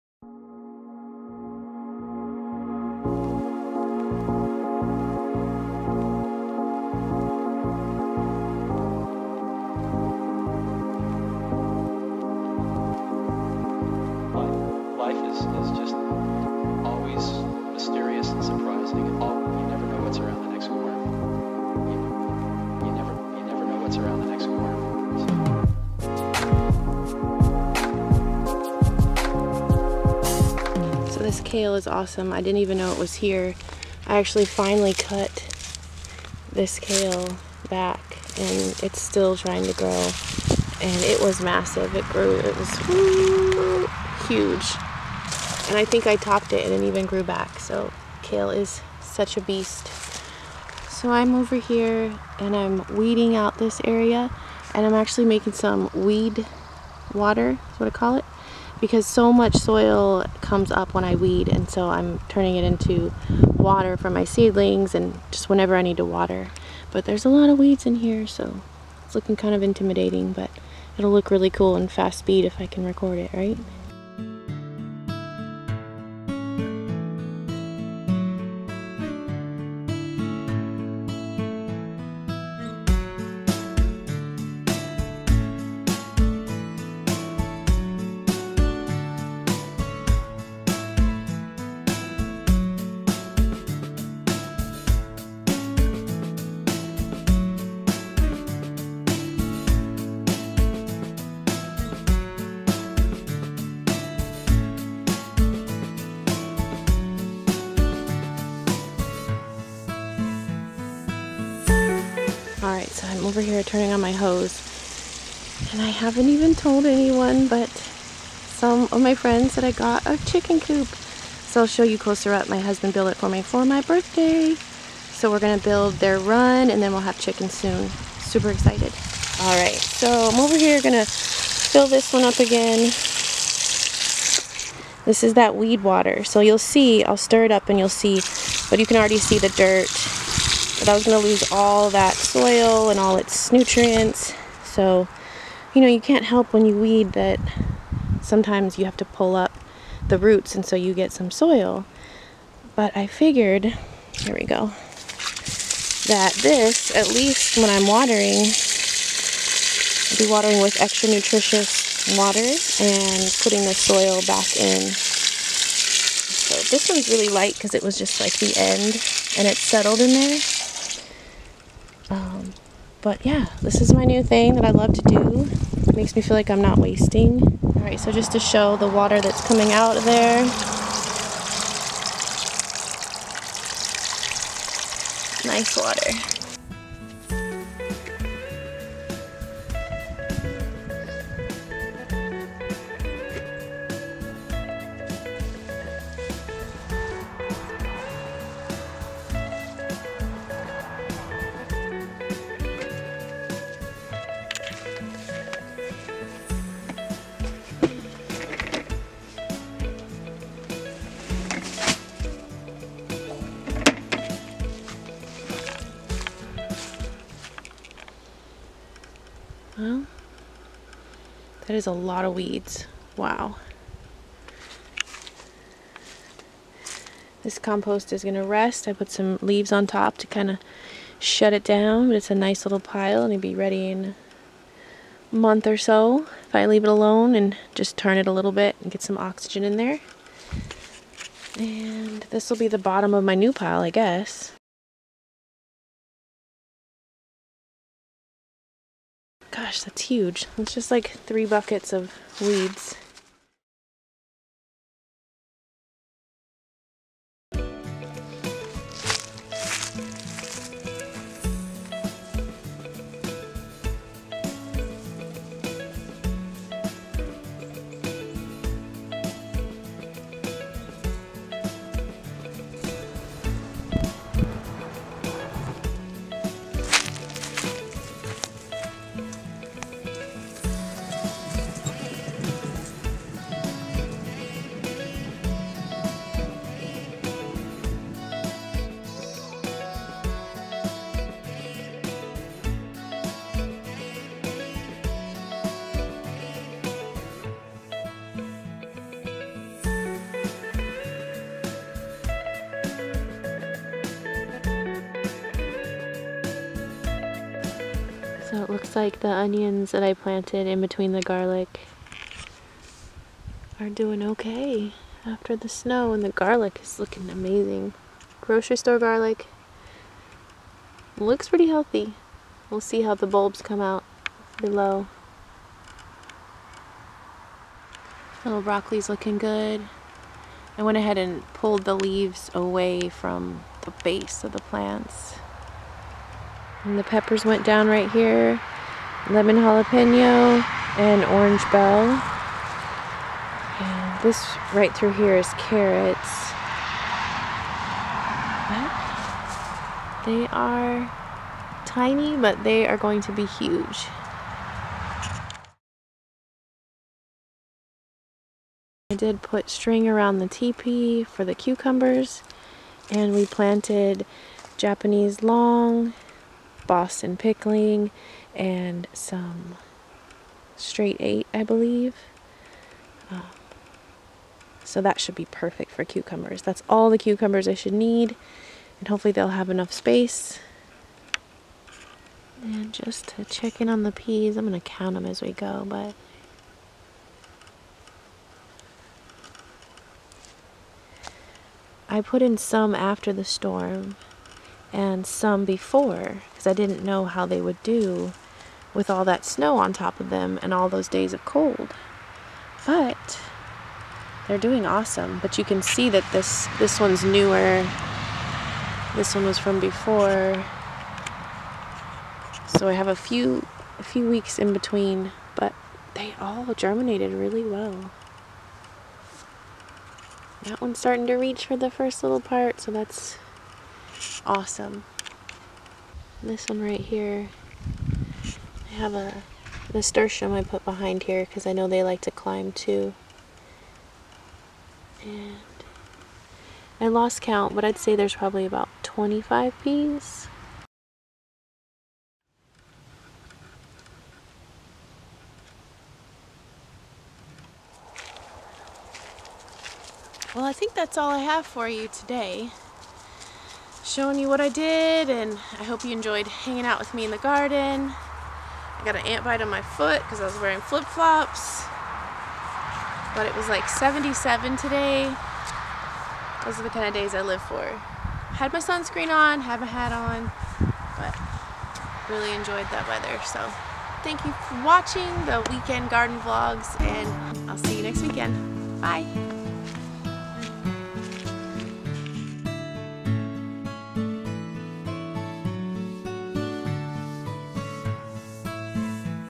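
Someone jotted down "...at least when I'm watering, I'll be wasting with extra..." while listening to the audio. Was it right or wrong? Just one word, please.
wrong.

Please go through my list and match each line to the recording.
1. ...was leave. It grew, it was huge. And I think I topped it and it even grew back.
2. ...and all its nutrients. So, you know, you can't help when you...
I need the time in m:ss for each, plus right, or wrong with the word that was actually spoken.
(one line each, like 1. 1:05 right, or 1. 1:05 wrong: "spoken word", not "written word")
1. 0:41 wrong: "massive", not "leave"
2. 2:22 right.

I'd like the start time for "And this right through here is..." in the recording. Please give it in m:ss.
5:43.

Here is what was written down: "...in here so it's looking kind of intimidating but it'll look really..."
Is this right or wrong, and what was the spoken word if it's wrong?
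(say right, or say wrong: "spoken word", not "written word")
right.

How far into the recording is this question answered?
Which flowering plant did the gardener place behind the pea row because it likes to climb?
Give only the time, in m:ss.
7:09.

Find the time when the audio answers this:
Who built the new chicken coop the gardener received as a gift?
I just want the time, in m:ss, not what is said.
2:02.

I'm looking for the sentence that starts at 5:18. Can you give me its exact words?
Grocery store garlic looks pretty healthy.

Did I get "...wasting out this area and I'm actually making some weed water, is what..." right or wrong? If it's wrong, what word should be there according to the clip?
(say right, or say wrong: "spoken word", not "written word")
wrong: "weeding", not "wasting".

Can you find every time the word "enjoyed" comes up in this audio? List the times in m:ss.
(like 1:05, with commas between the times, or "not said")
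7:36, 7:52.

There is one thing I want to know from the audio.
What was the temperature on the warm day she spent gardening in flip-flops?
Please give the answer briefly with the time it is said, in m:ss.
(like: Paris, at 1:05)
77, at 7:43.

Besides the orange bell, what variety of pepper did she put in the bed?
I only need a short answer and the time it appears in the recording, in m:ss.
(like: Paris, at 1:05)
Lemon jalapeno, at 5:39.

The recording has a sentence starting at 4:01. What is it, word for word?
And this will be the bottom of my new pile, I guess.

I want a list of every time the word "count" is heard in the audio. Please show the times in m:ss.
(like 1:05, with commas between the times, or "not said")
6:24, 7:17.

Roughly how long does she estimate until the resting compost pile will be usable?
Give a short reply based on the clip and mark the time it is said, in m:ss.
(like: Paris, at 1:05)
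a month, at 3:55.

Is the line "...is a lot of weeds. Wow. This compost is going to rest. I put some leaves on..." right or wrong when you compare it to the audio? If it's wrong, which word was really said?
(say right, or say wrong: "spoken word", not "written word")
right.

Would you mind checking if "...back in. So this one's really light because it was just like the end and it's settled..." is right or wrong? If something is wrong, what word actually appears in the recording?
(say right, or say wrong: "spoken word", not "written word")
right.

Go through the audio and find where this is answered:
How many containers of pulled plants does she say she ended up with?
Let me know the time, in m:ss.
4:11.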